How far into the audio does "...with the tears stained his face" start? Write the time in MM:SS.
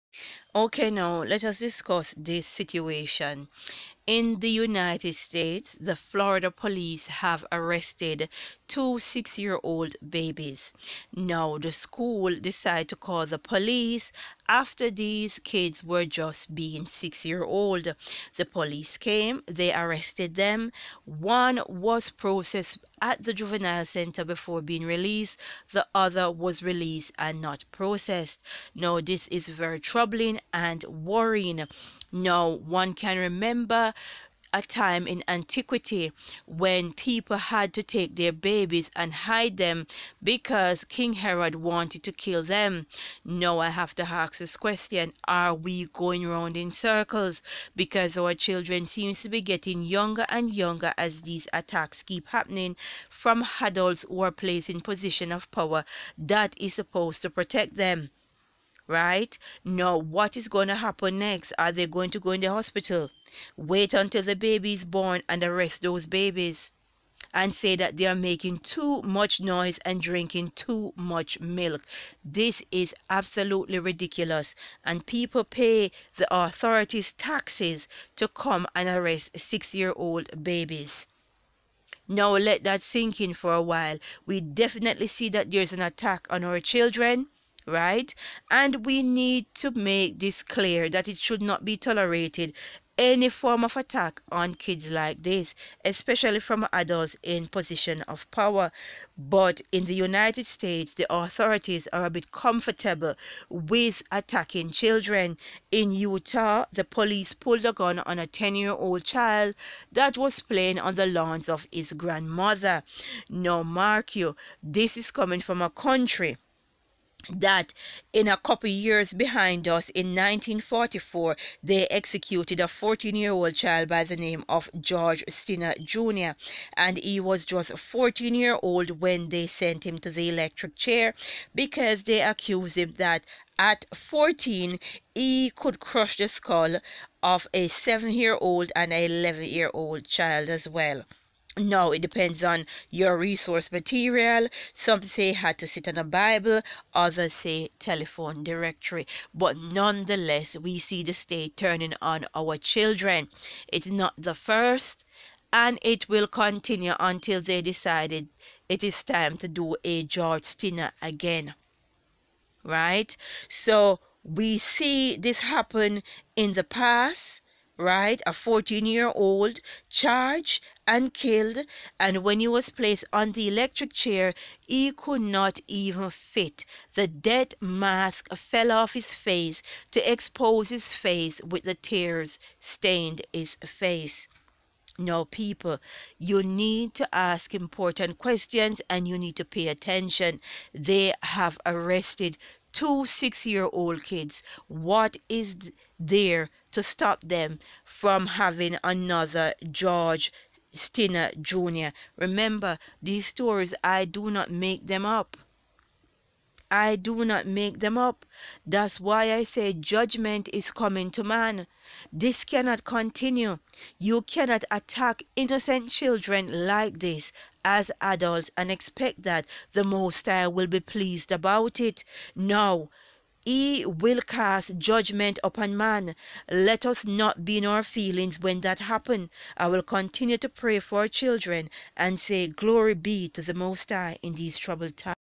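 03:01.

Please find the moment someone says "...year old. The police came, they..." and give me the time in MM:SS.
00:17.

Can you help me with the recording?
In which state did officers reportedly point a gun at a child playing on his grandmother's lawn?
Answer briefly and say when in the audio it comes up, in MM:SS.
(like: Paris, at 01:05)
Utah, at 01:45.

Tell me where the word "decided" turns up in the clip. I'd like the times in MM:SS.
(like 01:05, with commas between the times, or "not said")
00:12, 02:37.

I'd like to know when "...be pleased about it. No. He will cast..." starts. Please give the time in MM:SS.
03:40.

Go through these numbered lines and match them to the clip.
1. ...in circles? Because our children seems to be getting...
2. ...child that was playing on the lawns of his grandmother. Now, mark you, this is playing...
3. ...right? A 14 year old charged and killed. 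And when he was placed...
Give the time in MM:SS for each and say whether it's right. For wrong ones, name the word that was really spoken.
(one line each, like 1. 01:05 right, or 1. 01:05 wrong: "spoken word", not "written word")
1. 00:46 right
2. 01:49 wrong: "coming", not "playing"
3. 02:47 right.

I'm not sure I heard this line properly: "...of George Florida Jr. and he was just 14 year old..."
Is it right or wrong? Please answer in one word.
wrong.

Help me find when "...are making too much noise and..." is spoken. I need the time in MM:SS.
01:08.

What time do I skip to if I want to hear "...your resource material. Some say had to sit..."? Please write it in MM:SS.
02:22.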